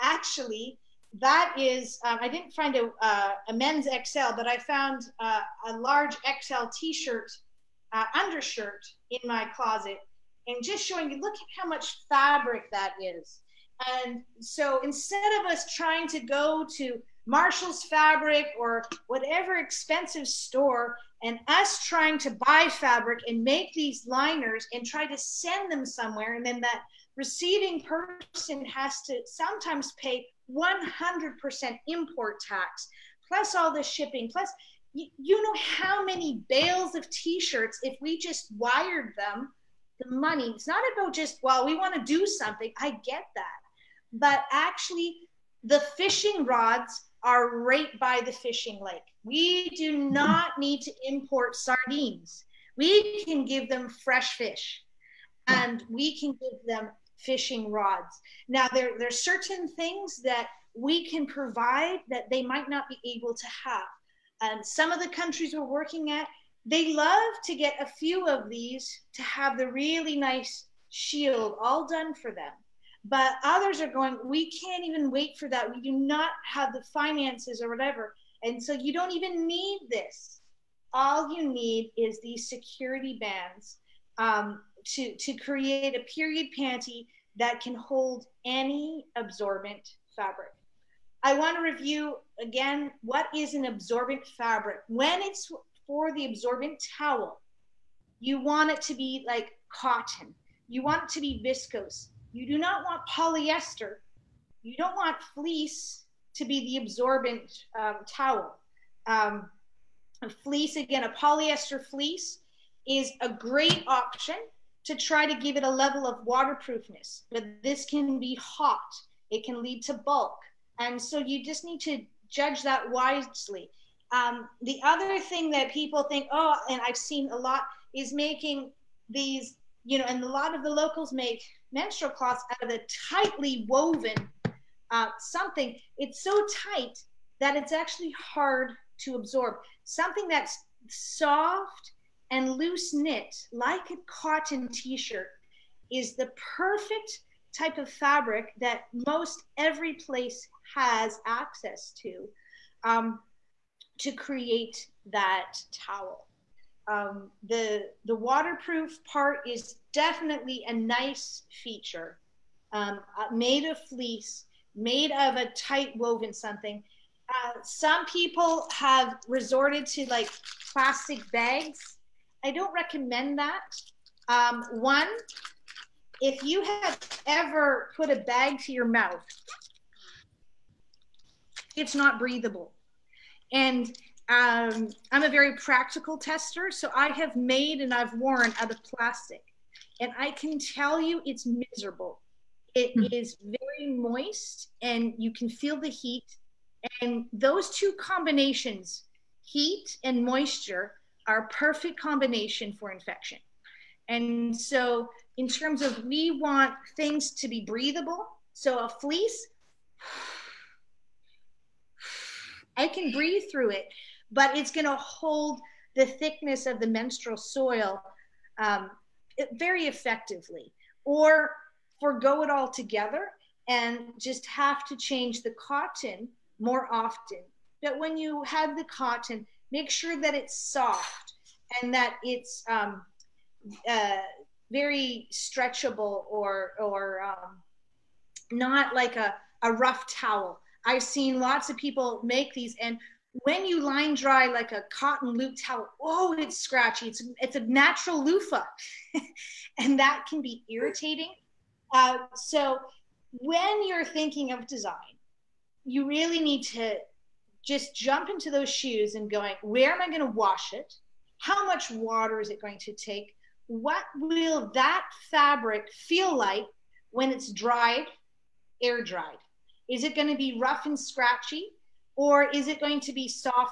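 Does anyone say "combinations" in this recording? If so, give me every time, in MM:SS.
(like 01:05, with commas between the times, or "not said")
03:17, 03:22.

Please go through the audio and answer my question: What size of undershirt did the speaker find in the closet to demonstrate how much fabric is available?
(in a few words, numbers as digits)
large XL.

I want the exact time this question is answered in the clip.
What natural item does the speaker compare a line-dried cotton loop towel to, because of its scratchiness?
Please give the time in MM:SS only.
04:08.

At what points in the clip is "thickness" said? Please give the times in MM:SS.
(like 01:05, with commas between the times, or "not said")
03:36.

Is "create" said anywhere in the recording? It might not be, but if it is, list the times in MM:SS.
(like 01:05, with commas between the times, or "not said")
01:25, 02:34.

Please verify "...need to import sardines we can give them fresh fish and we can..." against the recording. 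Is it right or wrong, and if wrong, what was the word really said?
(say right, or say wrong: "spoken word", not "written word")
right.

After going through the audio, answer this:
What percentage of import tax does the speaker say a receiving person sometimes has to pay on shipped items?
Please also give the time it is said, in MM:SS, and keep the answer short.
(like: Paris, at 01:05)
100%, at 00:30.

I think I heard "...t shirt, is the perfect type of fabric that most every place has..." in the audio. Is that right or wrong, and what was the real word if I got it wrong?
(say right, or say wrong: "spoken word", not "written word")
right.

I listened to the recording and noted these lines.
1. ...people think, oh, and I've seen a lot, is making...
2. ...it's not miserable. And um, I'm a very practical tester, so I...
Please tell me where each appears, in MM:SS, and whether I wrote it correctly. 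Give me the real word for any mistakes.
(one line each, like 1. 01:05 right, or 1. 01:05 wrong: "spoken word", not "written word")
1. 02:05 right
2. 03:01 wrong: "breathable", not "miserable".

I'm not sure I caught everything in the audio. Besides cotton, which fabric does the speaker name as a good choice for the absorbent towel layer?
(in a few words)
viscose.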